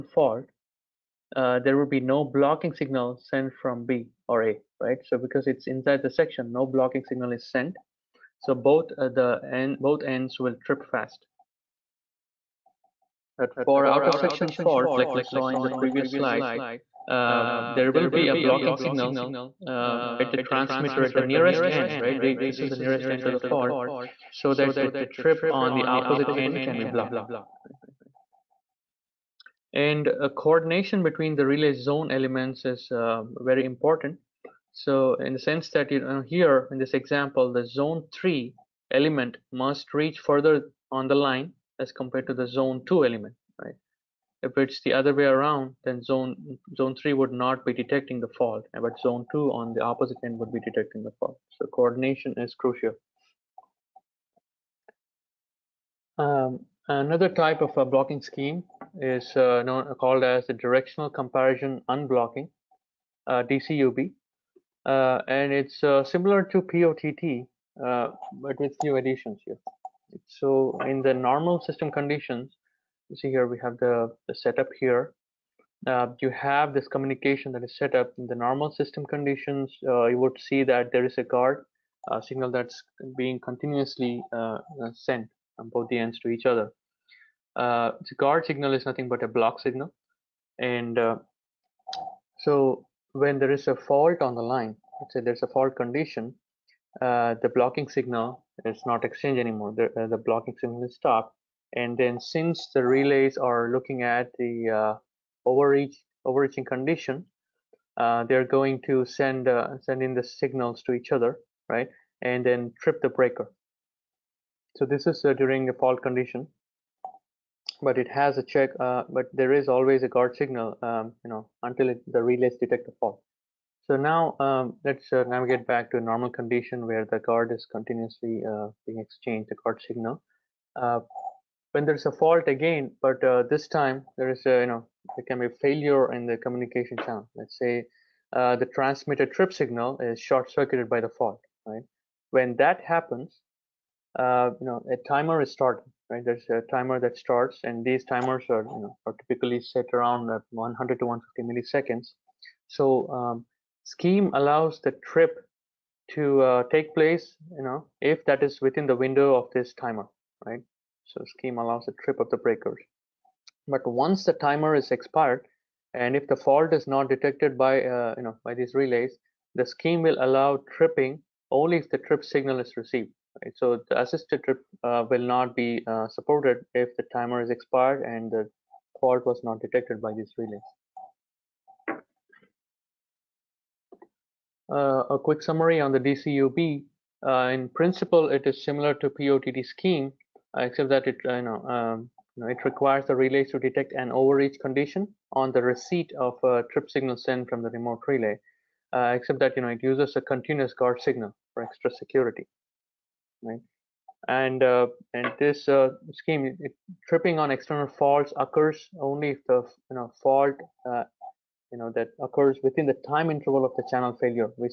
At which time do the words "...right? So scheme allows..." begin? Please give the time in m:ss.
2:40.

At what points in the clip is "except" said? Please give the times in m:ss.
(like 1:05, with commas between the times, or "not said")
3:10, 3:19.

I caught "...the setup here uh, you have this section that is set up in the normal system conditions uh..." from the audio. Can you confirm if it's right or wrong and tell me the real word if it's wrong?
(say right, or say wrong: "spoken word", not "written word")
wrong: "communication", not "section".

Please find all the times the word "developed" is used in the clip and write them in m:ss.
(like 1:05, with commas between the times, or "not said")
not said.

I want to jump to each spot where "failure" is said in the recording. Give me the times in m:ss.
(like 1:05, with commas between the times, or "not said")
2:15, 3:34.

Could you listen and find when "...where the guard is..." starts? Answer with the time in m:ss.
2:06.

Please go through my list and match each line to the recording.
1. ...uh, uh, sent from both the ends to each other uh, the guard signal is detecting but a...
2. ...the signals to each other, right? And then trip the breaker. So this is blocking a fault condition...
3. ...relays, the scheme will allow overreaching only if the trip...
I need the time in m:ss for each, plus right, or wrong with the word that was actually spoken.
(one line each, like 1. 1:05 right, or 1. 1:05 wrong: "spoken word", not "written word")
1. 1:24 wrong: "nothing", not "detecting"
2. 1:50 wrong: "during", not "blocking"
3. 2:48 wrong: "tripping", not "overreaching".